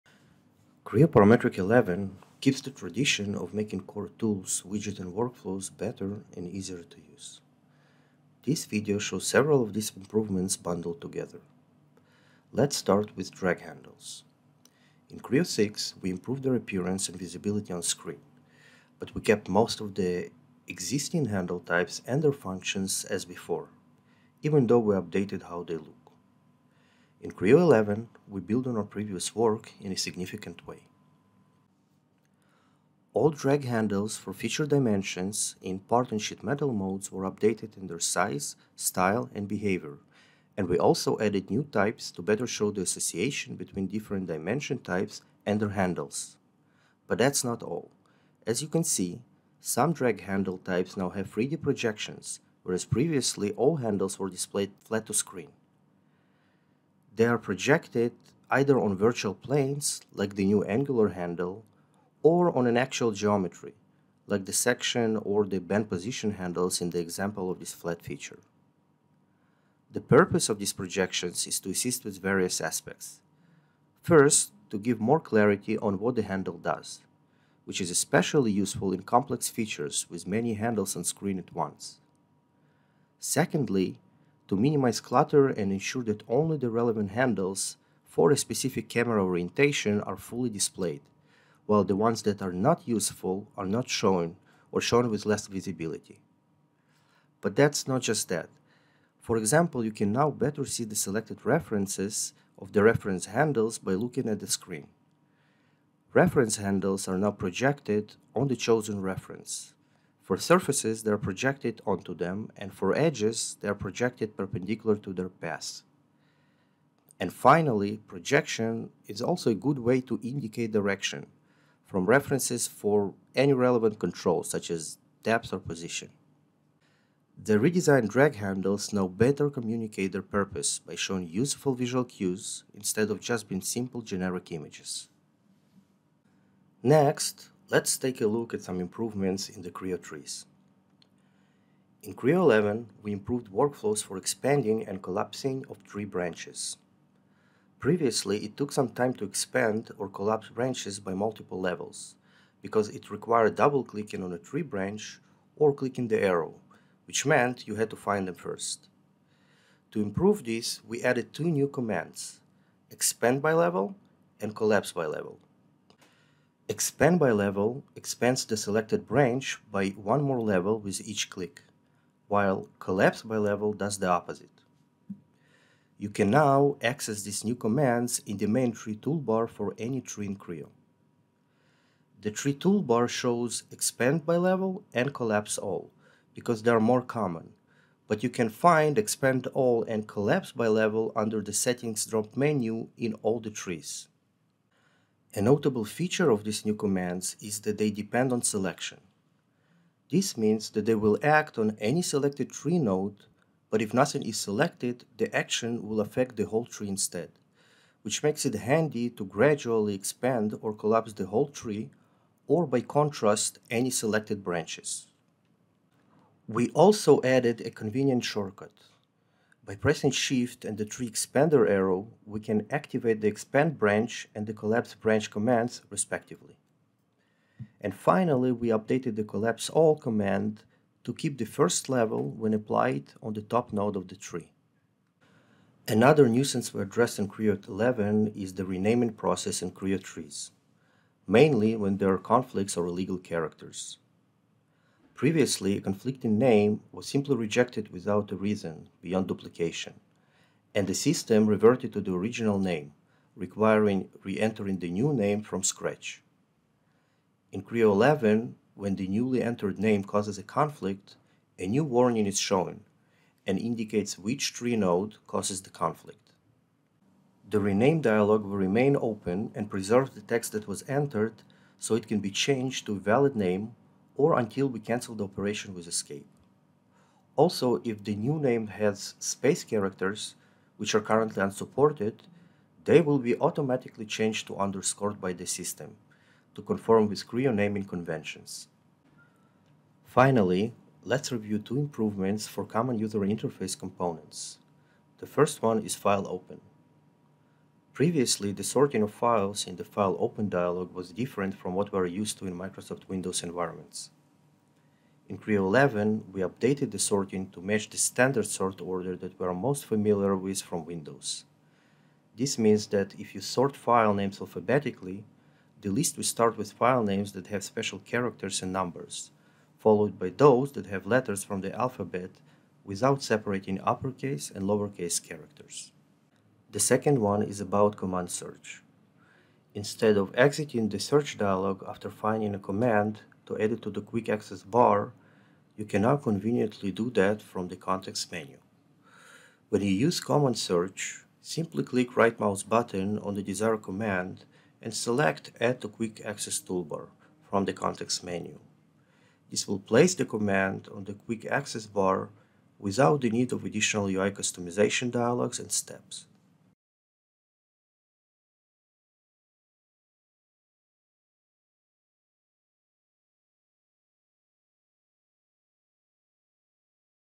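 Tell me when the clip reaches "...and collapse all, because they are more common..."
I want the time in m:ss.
3:04.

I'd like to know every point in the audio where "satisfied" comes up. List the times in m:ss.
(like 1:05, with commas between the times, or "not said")
not said.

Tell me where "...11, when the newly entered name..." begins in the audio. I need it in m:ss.
4:17.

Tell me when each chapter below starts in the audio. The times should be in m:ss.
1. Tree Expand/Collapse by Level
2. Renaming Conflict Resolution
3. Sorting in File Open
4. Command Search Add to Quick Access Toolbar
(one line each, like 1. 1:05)
1. 2:16
2. 3:55
3. 4:50
4. 5:26.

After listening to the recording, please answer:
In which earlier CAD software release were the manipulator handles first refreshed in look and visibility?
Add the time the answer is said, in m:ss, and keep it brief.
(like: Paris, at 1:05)
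Creo 6, at 0:15.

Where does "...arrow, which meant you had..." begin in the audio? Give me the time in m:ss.
2:36.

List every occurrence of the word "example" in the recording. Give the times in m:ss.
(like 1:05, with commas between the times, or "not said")
1:06, 1:39.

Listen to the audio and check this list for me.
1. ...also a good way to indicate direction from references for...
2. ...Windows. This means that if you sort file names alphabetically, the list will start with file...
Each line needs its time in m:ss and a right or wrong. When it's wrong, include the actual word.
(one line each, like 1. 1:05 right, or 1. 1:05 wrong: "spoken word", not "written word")
1. 1:59 right
2. 5:10 right.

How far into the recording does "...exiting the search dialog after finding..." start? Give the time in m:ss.
5:30.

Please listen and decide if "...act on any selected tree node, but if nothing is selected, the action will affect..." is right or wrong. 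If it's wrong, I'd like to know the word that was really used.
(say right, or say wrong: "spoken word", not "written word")
right.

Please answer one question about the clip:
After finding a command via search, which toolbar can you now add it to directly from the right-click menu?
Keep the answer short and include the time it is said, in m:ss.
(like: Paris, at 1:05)
Quick Access toolbar, at 5:45.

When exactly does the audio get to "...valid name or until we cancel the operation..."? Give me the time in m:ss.
4:32.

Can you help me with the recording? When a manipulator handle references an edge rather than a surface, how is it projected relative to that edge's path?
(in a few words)
Perpendicular.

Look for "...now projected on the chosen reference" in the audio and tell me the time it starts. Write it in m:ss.
1:47.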